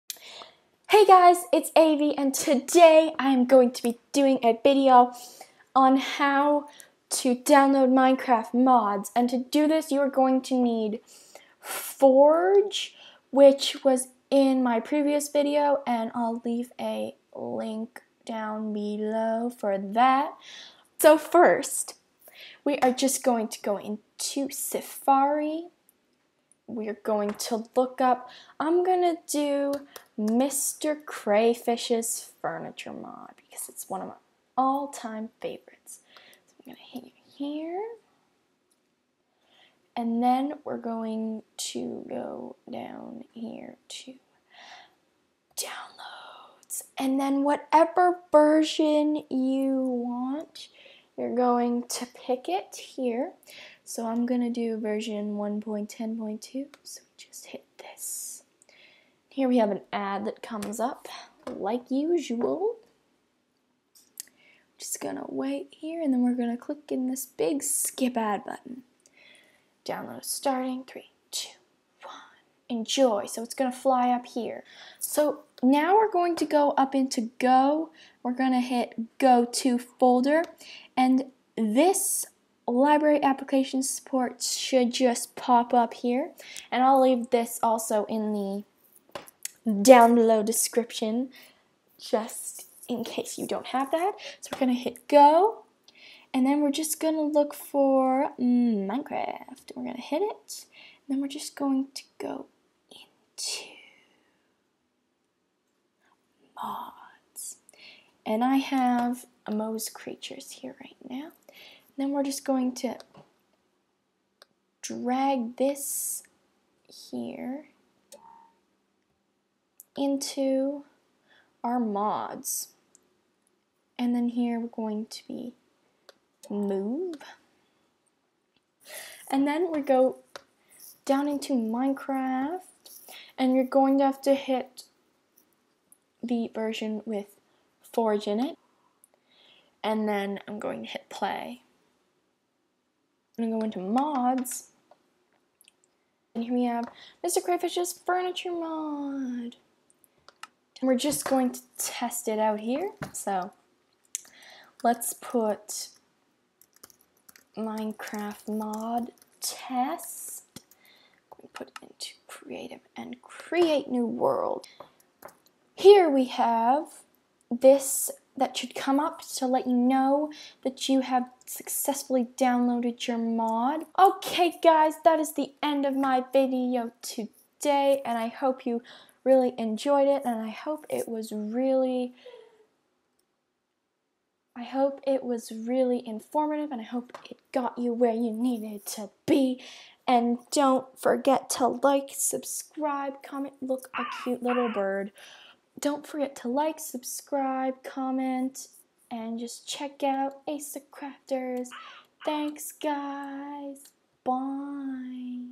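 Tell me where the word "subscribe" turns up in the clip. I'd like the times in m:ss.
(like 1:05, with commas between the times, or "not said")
3:12, 3:16.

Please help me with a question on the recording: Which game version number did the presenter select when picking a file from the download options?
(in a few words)
1.10.2.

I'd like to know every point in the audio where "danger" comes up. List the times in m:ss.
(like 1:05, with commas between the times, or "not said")
not said.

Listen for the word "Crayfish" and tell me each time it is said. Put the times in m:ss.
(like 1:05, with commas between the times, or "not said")
0:31, 2:27.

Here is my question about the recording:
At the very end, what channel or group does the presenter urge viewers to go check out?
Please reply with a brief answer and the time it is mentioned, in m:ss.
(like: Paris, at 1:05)
Ace of Crafters, at 3:20.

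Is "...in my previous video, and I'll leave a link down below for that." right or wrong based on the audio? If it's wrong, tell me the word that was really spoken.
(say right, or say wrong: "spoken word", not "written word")
right.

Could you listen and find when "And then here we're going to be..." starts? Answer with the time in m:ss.
2:03.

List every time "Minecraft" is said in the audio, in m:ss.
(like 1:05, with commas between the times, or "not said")
0:07, 1:38, 2:11, 2:37.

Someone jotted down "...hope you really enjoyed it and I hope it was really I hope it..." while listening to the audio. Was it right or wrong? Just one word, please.
right.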